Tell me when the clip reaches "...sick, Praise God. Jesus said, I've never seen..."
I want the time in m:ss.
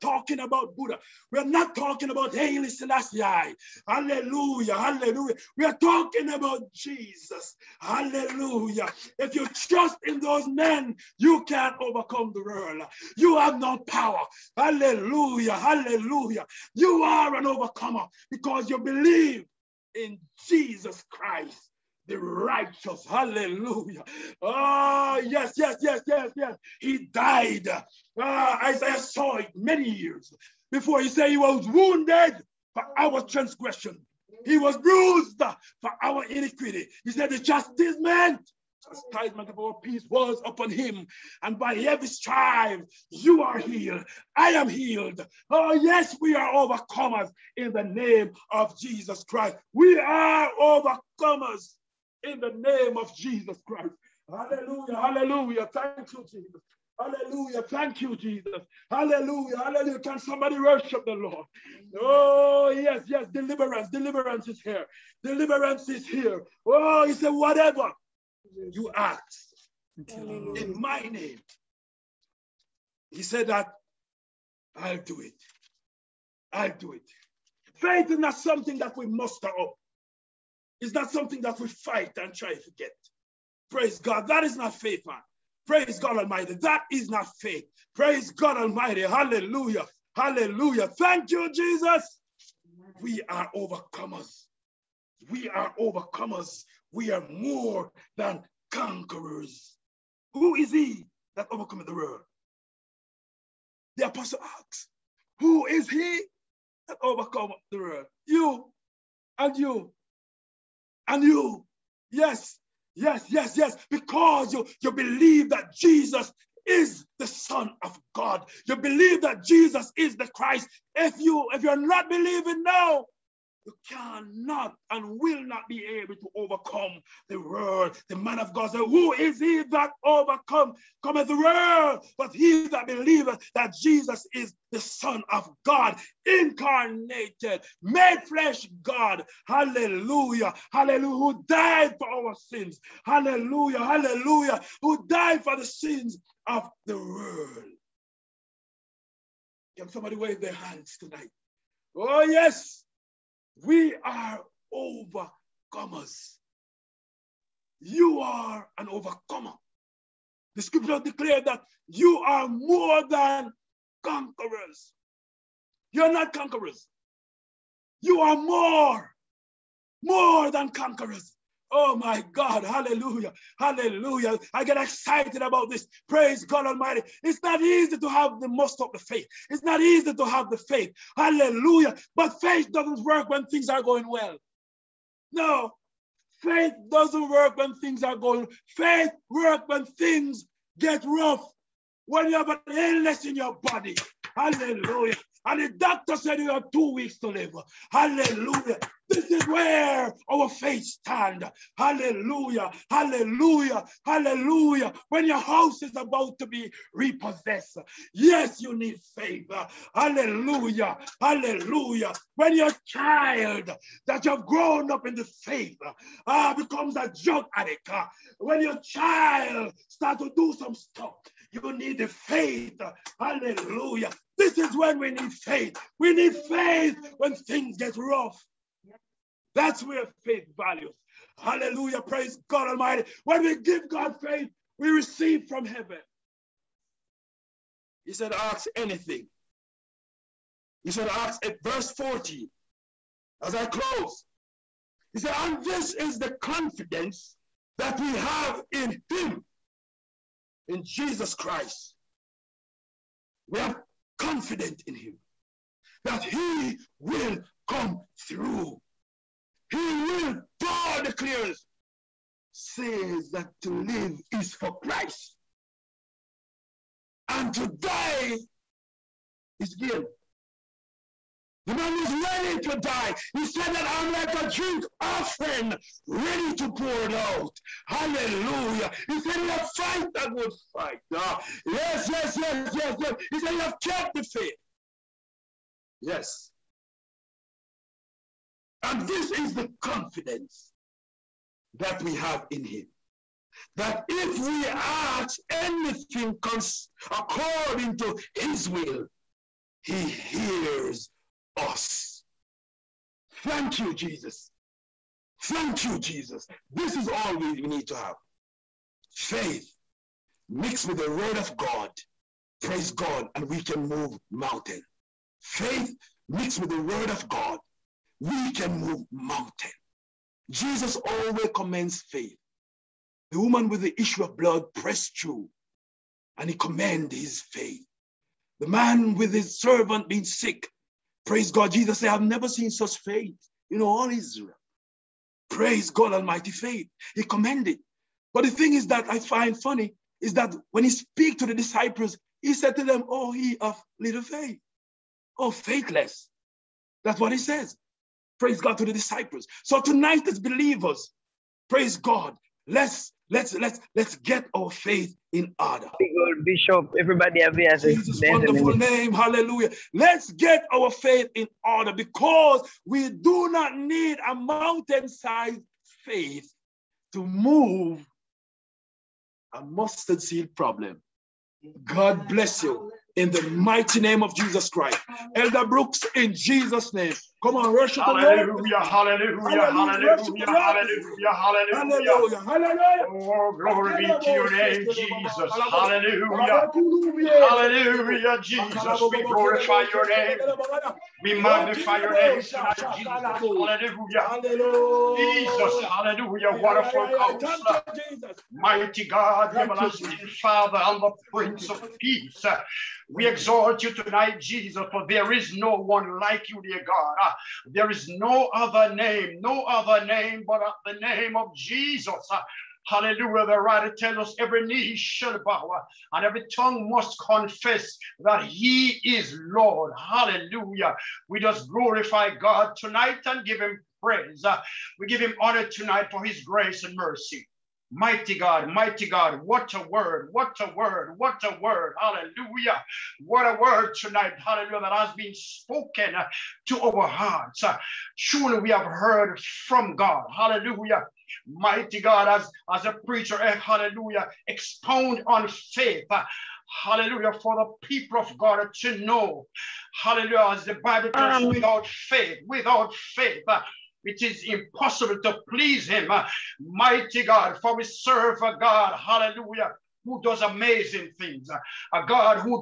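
5:30.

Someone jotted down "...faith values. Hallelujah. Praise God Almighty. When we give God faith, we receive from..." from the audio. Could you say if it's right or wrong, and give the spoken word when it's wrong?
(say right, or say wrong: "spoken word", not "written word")
right.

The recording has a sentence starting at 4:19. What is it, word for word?
He will, Paul declares, says that to live is for Christ and to die is gain.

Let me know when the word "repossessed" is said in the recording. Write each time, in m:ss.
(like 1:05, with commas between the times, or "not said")
3:26.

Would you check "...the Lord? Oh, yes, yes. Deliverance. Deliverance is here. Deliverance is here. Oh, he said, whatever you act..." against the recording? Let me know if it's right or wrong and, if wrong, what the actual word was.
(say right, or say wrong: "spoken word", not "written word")
right.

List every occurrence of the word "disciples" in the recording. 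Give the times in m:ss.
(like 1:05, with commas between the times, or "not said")
5:41, 5:48.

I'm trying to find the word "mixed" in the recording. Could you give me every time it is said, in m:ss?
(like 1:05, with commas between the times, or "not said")
5:10, 5:16.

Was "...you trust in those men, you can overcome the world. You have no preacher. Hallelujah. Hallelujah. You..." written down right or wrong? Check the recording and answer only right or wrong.
wrong.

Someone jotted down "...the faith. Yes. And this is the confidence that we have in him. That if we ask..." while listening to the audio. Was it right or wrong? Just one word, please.
right.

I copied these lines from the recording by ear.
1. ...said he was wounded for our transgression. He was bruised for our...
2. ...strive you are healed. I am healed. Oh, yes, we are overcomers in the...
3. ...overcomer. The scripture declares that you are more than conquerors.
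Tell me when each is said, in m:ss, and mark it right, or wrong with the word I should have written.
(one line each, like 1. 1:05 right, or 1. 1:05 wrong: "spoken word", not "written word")
1. 0:31 right
2. 0:42 right
3. 2:38 right.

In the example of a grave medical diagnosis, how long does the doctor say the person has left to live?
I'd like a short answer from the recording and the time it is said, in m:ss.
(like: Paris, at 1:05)
Two weeks, at 3:16.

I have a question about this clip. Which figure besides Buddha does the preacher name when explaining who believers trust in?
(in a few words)
Haile Selassie.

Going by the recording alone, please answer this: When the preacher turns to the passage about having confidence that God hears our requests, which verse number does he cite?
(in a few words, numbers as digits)
40.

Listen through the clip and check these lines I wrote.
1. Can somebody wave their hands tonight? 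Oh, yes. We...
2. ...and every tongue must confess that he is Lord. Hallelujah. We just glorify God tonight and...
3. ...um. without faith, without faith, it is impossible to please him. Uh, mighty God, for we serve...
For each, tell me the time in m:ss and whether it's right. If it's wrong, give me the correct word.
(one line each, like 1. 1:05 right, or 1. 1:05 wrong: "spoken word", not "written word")
1. 2:29 right
2. 6:56 right
3. 7:31 right.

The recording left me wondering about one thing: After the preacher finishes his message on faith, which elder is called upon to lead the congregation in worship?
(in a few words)
Elder Brooks.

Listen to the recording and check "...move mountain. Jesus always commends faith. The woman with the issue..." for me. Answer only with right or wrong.
right.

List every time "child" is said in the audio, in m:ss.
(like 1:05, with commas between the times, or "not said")
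3:32, 3:38.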